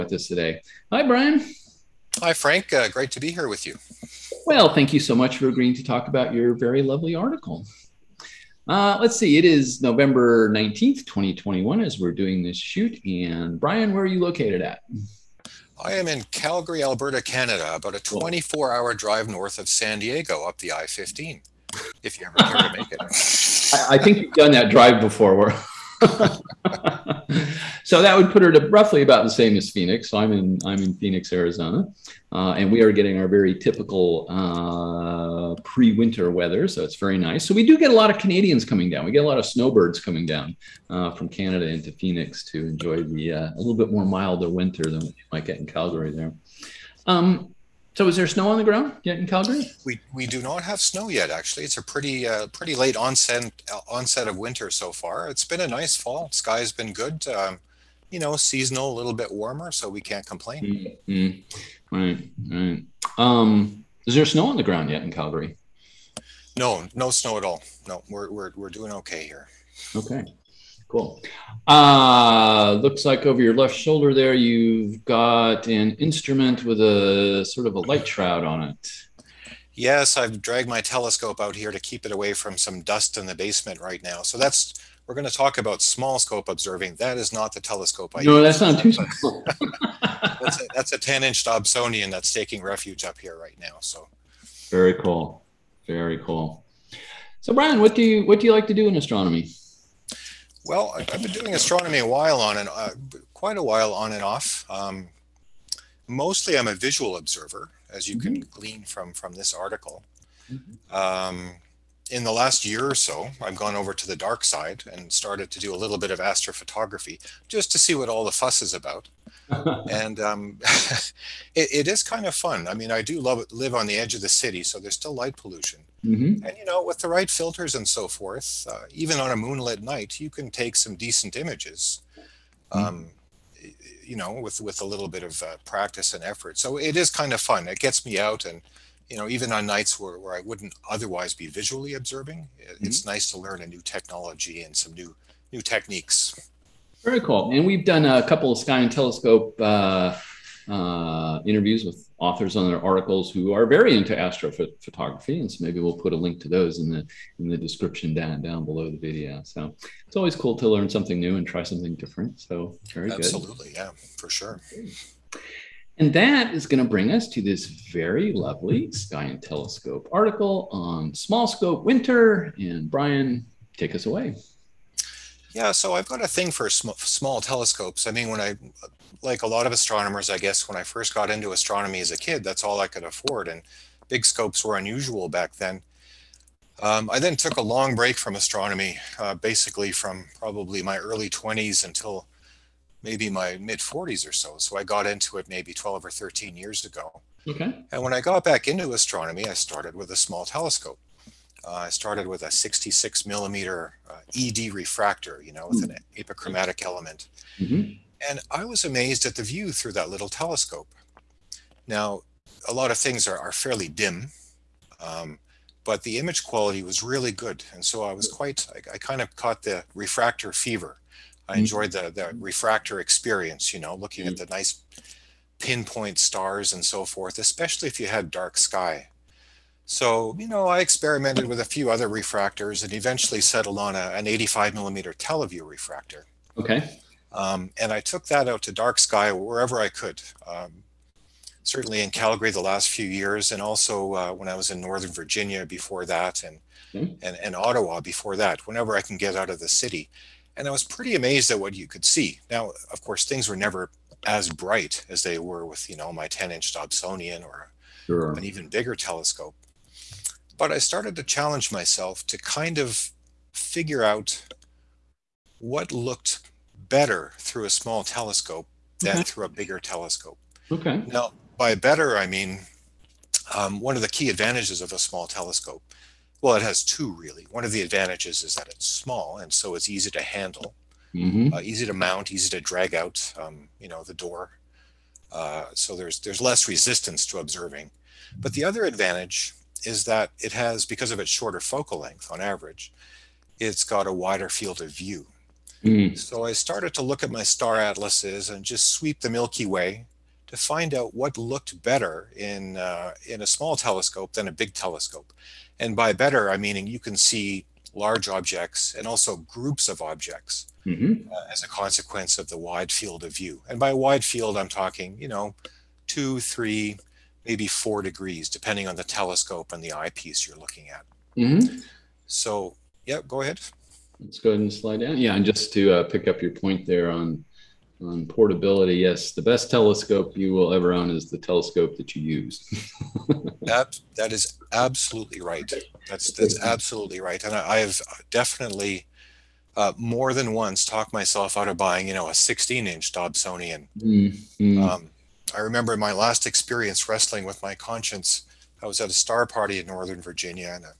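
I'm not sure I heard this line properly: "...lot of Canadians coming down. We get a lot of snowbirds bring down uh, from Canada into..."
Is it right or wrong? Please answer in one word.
wrong.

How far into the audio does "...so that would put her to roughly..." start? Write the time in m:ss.
0:27.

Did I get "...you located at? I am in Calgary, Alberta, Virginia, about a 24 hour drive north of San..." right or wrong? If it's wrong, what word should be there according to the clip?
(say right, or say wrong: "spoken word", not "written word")
wrong: "Canada", not "Virginia".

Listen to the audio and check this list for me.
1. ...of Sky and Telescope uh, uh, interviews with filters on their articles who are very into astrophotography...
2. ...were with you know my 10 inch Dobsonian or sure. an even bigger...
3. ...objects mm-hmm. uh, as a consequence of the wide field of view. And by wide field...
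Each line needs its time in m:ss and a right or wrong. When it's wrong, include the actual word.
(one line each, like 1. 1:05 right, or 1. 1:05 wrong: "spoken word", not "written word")
1. 2:28 wrong: "authors", not "filters"
2. 4:15 right
3. 5:10 right.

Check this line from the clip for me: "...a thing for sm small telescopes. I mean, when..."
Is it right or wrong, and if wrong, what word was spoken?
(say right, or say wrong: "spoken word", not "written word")
right.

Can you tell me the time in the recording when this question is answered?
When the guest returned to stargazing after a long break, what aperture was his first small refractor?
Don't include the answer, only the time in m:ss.
3:22.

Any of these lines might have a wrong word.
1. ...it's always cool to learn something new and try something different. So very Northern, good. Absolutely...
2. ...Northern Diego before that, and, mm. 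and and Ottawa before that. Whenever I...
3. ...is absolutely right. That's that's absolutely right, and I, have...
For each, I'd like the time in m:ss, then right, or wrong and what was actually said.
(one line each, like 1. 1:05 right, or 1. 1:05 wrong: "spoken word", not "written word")
1. 2:40 wrong: "Absolutely", not "Northern"
2. 4:04 wrong: "Virginia", not "Diego"
3. 5:34 right.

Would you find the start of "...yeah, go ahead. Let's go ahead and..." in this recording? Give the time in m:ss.
5:23.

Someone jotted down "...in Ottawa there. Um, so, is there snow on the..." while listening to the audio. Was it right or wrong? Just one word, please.
wrong.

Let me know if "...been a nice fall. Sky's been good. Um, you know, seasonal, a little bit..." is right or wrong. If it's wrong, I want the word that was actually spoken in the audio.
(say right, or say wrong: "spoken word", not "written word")
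right.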